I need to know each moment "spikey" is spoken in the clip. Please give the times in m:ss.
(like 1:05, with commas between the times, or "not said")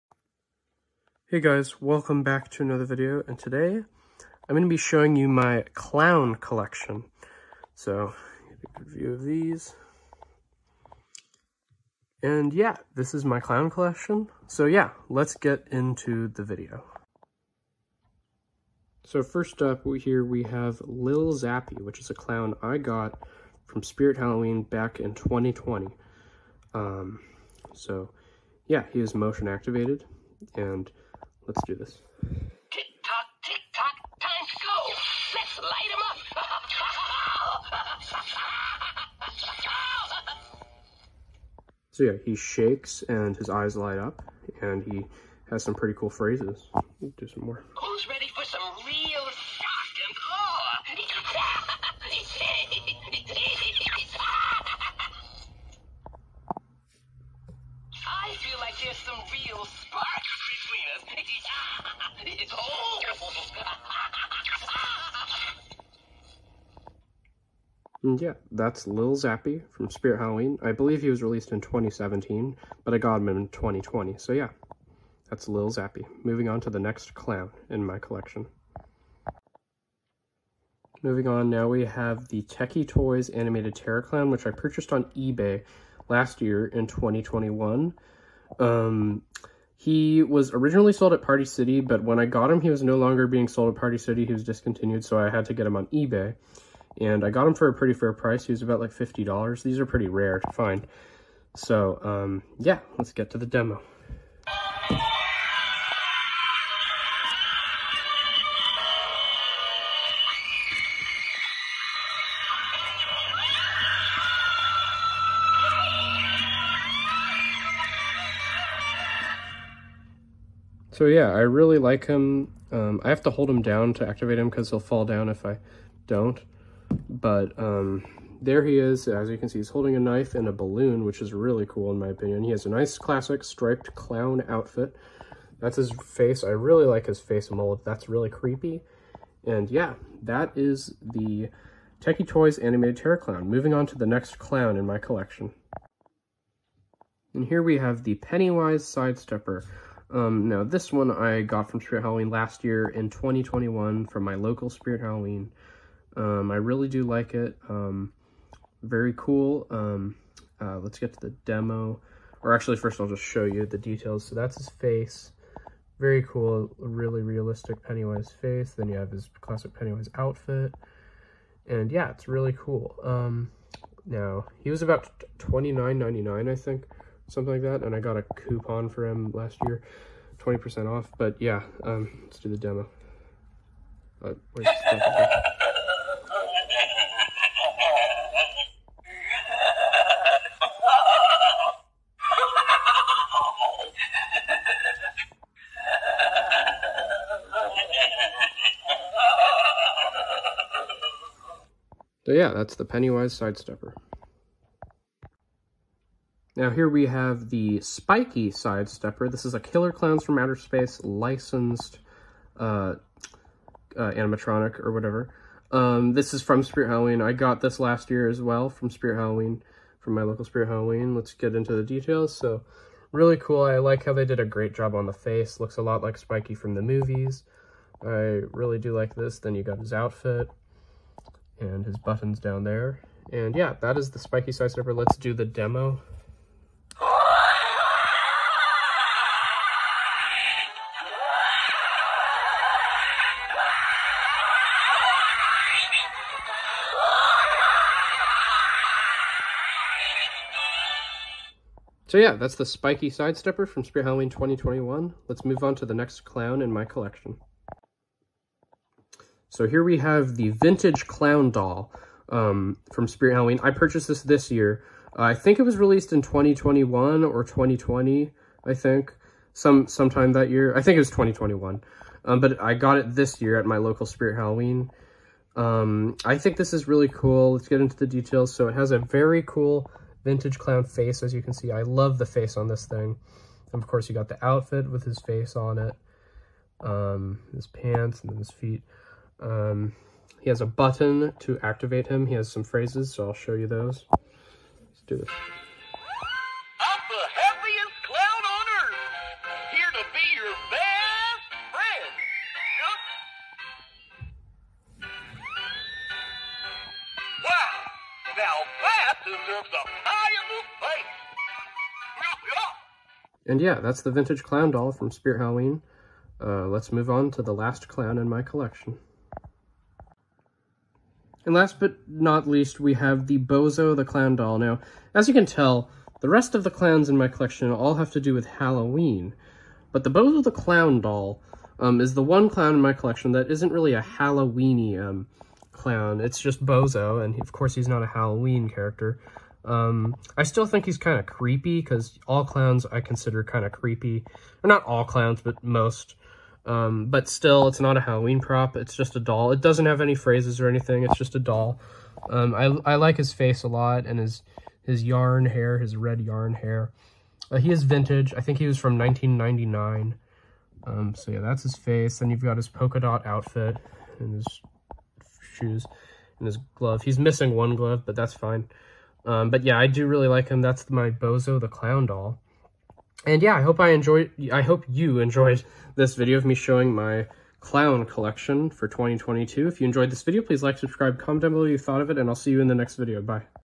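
3:27, 3:46, 3:54, 4:12.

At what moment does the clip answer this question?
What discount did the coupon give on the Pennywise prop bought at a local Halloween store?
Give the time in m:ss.
3:00.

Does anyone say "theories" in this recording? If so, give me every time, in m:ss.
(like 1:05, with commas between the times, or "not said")
not said.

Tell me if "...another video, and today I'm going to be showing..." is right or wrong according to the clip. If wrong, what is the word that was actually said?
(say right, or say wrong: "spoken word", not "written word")
right.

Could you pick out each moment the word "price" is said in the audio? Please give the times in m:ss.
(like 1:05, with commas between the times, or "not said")
1:38.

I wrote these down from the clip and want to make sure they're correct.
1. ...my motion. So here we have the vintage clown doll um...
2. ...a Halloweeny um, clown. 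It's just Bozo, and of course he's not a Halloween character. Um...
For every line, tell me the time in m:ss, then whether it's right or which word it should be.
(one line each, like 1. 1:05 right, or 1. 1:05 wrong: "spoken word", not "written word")
1. 4:16 wrong: "collection", not "motion"
2. 5:33 right.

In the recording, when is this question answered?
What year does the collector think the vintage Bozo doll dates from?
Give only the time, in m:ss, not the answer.
5:58.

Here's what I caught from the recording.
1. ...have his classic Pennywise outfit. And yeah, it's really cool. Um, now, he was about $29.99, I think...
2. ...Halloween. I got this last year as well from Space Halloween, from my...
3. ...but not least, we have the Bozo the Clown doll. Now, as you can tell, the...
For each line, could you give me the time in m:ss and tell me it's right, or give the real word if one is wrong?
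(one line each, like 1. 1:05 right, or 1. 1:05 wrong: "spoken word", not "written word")
1. 2:48 right
2. 3:36 wrong: "Spirit", not "Space"
3. 5:21 right.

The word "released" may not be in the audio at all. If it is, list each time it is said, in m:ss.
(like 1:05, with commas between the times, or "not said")
1:11, 4:25.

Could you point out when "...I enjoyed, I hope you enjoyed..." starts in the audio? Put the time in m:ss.
6:13.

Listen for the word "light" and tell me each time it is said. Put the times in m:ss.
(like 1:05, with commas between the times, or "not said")
0:35, 0:43.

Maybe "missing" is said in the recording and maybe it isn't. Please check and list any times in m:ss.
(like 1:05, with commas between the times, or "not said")
6:07.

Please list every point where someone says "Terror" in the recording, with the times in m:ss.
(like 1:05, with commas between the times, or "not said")
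1:23, 2:22.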